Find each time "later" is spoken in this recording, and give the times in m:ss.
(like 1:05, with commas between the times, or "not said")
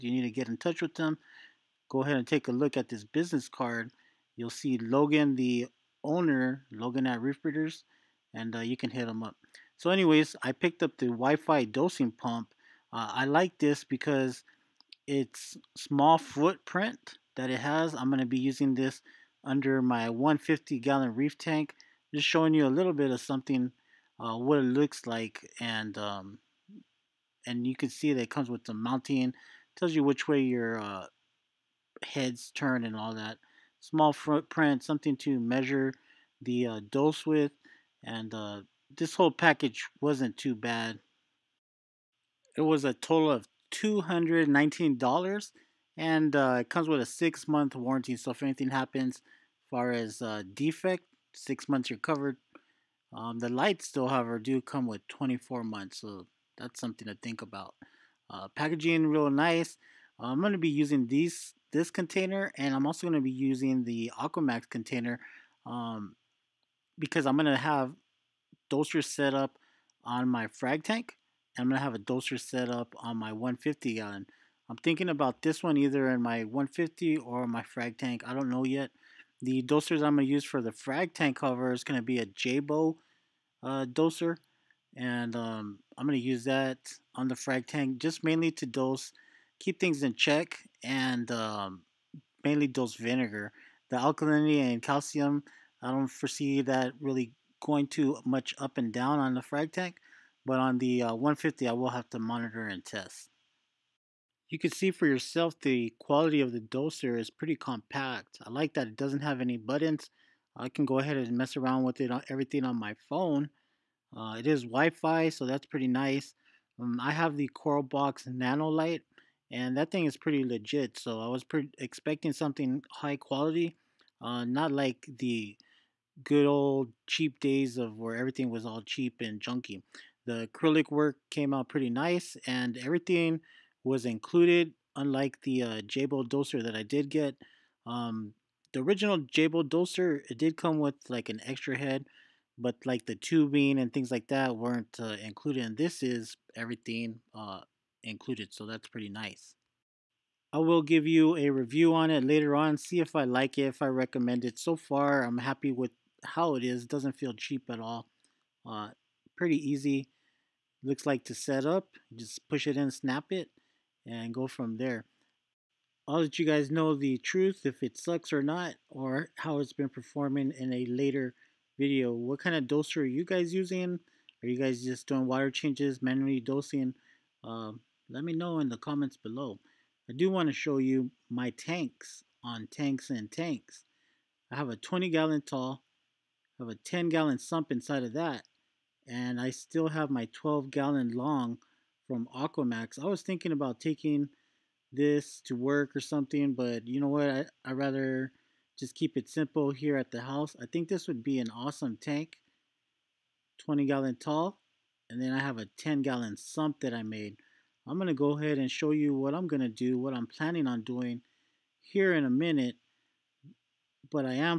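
2:32, 2:50.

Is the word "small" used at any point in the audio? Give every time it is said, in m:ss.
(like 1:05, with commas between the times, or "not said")
0:15, 0:33.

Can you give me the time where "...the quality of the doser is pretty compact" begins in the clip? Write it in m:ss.
1:45.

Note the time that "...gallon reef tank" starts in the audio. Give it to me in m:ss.
0:20.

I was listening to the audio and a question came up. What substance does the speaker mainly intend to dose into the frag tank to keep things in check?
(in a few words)
Vinegar.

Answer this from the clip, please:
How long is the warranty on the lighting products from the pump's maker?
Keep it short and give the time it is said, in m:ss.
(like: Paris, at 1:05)
24 months, at 0:55.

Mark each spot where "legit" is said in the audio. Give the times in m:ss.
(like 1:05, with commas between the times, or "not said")
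2:00.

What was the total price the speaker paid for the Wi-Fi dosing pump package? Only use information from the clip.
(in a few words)
$219.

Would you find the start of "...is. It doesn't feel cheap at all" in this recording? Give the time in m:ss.
2:36.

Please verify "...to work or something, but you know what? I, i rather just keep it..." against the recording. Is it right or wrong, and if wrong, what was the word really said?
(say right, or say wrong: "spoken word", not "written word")
right.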